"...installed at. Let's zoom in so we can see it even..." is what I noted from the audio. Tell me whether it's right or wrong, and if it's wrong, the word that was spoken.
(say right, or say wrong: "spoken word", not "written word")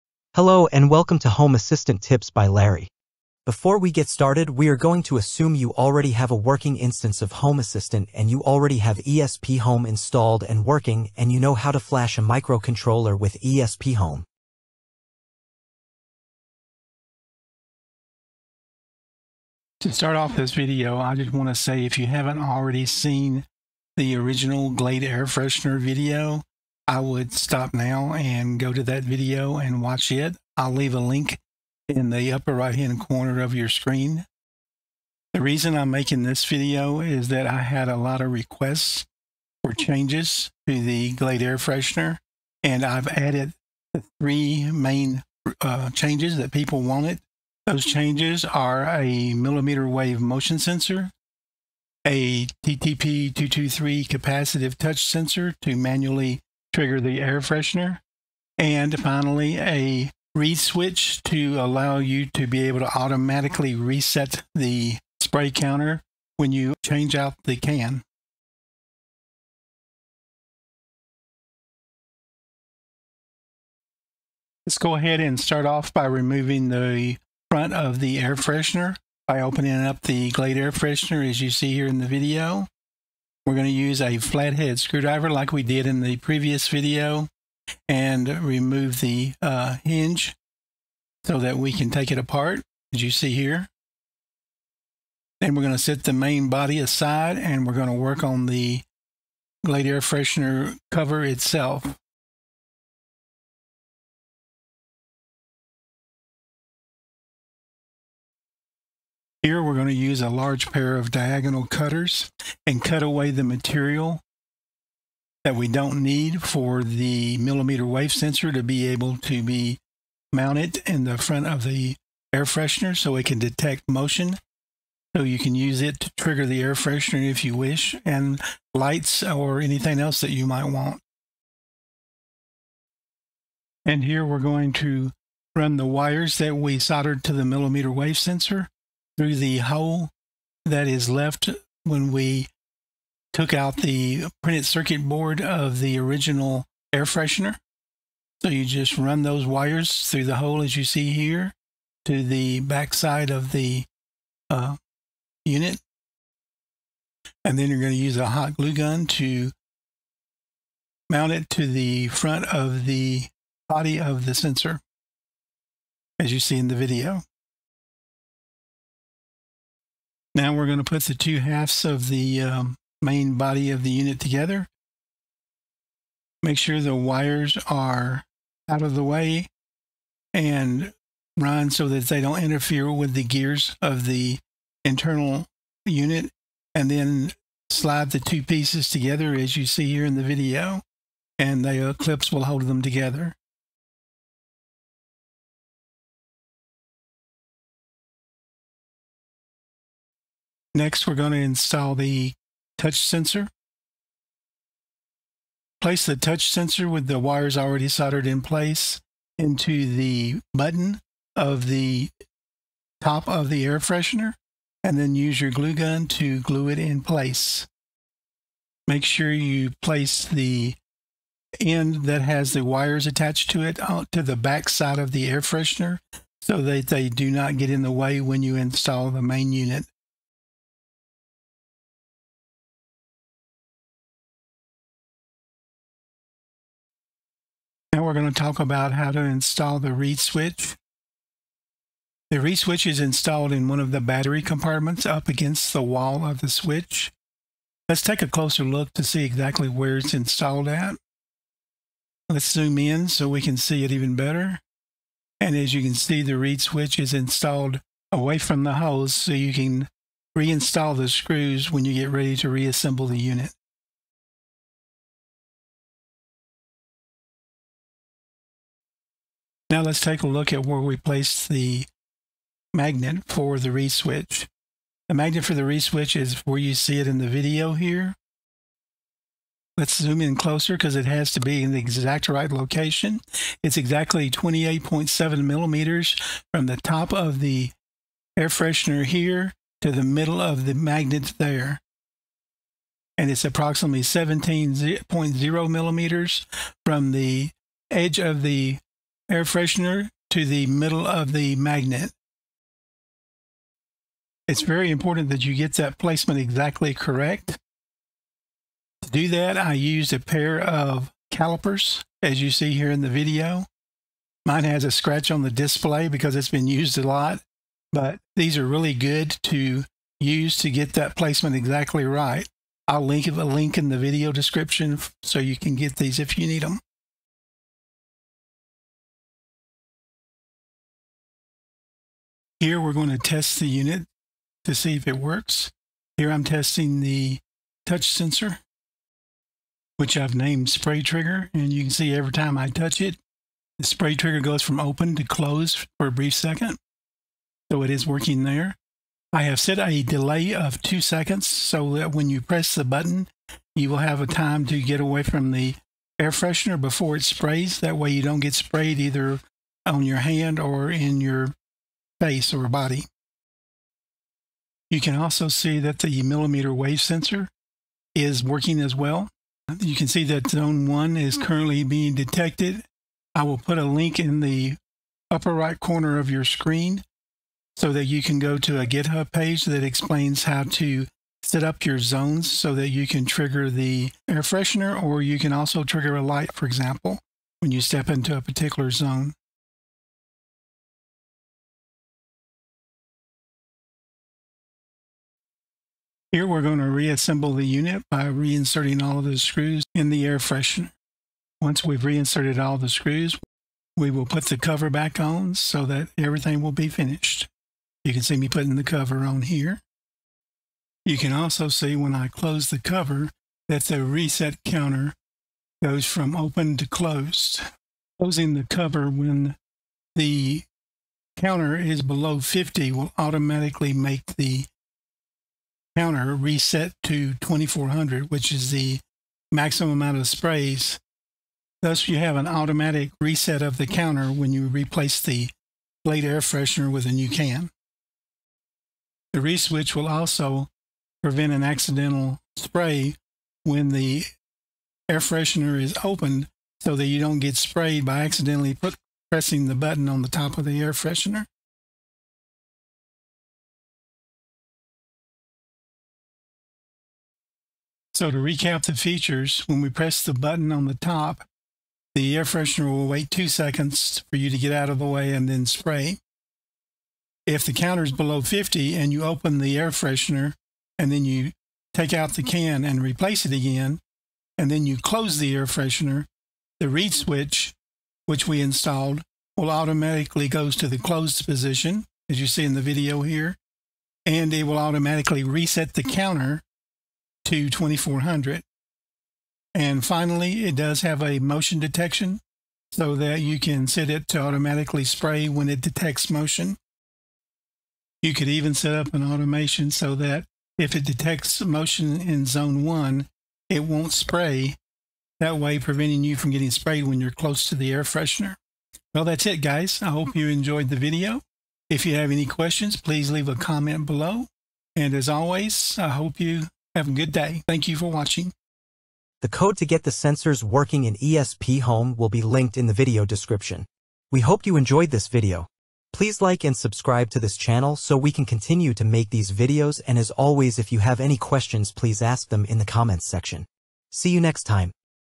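right.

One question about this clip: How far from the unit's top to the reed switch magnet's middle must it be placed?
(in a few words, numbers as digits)
28.7 millimeters.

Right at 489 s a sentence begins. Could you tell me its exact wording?
And finally, it does have a motion detection so that you can set it to automatically spray when it detects motion.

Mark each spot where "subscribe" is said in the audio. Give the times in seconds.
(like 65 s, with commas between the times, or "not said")
526 s.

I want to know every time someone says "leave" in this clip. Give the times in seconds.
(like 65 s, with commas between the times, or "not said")
30 s, 513 s.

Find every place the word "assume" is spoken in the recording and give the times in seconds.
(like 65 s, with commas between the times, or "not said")
5 s.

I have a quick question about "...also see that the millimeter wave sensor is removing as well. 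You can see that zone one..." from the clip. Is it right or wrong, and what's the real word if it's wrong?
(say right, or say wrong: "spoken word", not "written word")
wrong: "working", not "removing".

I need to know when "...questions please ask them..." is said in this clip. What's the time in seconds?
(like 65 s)
531 s.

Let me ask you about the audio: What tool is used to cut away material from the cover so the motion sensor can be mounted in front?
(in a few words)
diagonal cutters.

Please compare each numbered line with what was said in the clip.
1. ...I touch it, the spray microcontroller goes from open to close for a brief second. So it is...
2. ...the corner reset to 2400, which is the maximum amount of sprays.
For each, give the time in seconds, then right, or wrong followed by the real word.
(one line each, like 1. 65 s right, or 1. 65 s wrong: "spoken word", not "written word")
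1. 342 s wrong: "trigger", not "microcontroller"
2. 424 s wrong: "counter", not "corner".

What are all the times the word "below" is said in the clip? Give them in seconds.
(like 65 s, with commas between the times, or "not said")
422 s, 468 s, 514 s.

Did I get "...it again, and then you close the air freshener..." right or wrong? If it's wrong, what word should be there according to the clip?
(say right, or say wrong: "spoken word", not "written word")
right.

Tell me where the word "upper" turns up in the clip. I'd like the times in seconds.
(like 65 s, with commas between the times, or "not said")
32 s, 375 s.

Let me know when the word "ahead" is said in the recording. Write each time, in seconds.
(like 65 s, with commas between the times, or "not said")
74 s.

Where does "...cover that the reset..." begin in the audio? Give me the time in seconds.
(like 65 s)
412 s.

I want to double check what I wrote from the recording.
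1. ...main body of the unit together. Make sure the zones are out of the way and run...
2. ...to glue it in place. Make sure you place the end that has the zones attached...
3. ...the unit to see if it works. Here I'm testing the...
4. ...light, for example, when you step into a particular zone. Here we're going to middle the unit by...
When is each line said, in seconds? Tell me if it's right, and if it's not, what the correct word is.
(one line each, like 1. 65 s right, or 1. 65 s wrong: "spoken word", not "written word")
1. 173 s wrong: "wires", not "zones"
2. 216 s wrong: "wires", not "zones"
3. 333 s right
4. 386 s wrong: "reassemble", not "middle".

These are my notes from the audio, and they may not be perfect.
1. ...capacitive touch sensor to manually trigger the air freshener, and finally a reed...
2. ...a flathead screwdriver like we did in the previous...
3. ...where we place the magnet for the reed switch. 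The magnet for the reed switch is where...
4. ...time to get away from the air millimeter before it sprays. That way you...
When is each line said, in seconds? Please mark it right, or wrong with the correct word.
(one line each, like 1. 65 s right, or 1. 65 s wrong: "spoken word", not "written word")
1. 54 s right
2. 84 s right
3. 270 s right
4. 354 s wrong: "freshener", not "millimeter".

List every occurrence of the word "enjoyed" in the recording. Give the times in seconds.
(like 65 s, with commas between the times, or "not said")
510 s, 524 s.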